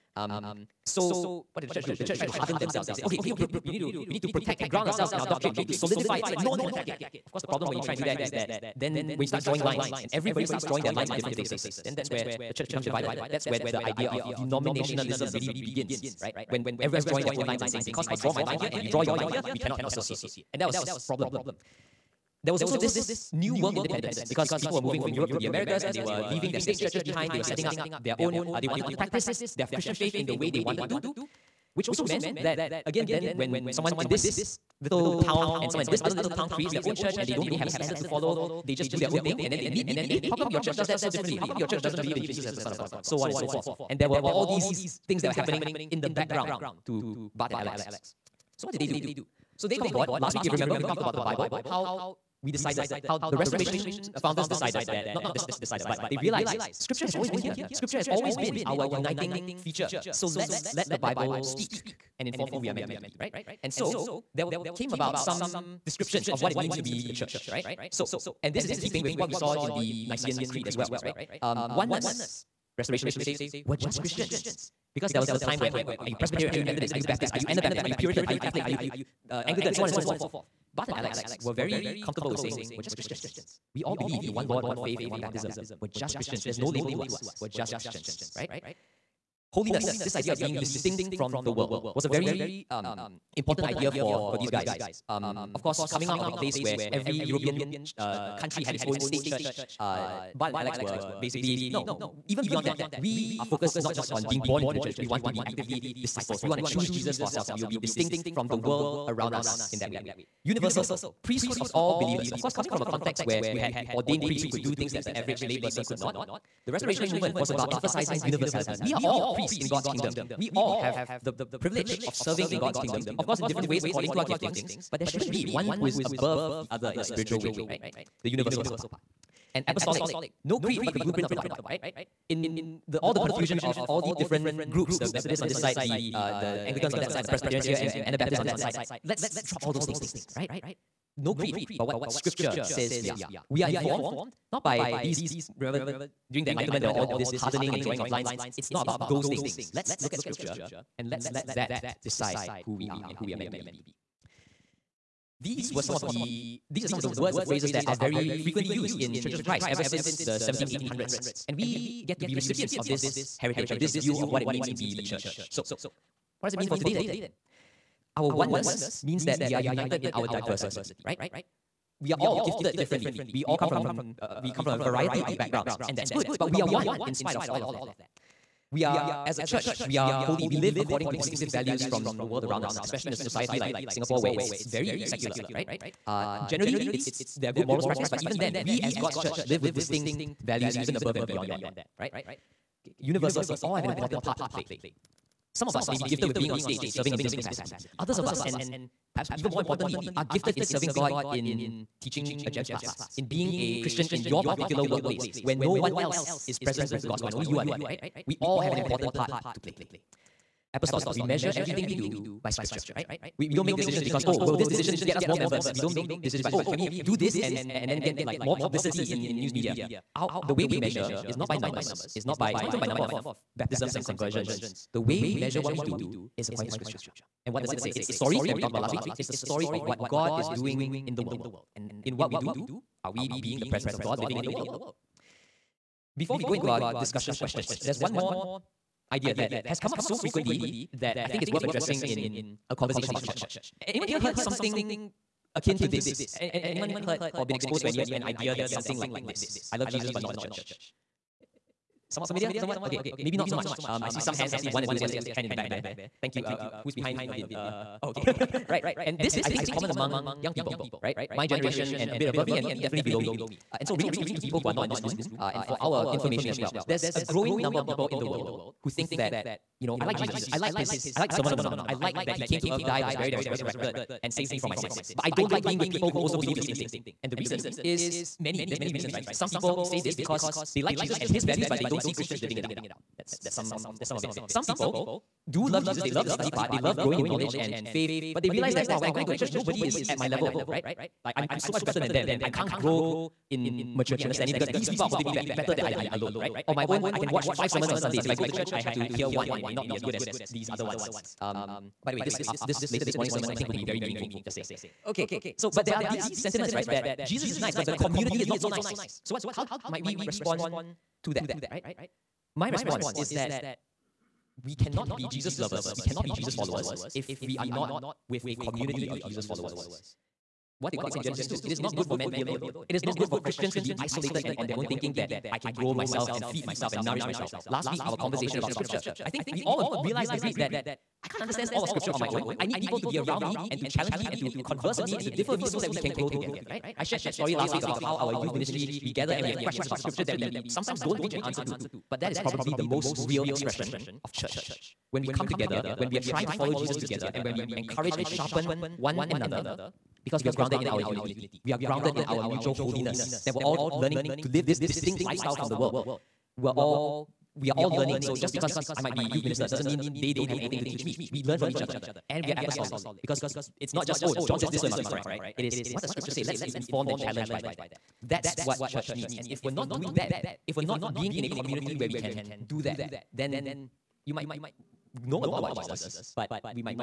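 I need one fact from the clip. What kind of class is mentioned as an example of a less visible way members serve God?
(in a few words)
GEMS class.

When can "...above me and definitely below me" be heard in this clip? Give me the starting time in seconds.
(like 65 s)
262 s.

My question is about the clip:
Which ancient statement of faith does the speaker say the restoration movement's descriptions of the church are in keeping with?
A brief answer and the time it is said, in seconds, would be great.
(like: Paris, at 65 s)
Nicene Creed, at 70 s.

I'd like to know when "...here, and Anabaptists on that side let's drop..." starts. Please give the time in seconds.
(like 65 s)
137 s.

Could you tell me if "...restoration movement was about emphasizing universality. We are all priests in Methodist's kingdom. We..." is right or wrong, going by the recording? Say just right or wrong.
wrong.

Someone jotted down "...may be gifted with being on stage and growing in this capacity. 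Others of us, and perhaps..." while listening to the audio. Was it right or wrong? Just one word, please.
wrong.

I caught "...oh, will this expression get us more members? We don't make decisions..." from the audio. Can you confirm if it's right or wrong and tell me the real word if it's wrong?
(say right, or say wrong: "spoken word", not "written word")
wrong: "decision", not "expression".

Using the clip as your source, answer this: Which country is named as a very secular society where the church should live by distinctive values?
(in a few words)
Singapore.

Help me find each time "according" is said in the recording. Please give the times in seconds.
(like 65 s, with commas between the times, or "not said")
123 s, 180 s, 226 s.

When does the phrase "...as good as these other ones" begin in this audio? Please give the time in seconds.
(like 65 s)
299 s.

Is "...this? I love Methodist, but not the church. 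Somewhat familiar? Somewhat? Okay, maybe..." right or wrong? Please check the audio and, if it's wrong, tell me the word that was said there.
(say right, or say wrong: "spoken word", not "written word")
wrong: "Jesus", not "Methodist".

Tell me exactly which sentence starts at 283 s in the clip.
That's, that's, some, of, that's some of it.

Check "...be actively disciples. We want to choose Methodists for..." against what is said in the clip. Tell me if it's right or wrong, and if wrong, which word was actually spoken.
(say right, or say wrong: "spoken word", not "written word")
wrong: "Jesus", not "Methodists".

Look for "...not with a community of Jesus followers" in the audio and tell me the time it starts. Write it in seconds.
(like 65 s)
317 s.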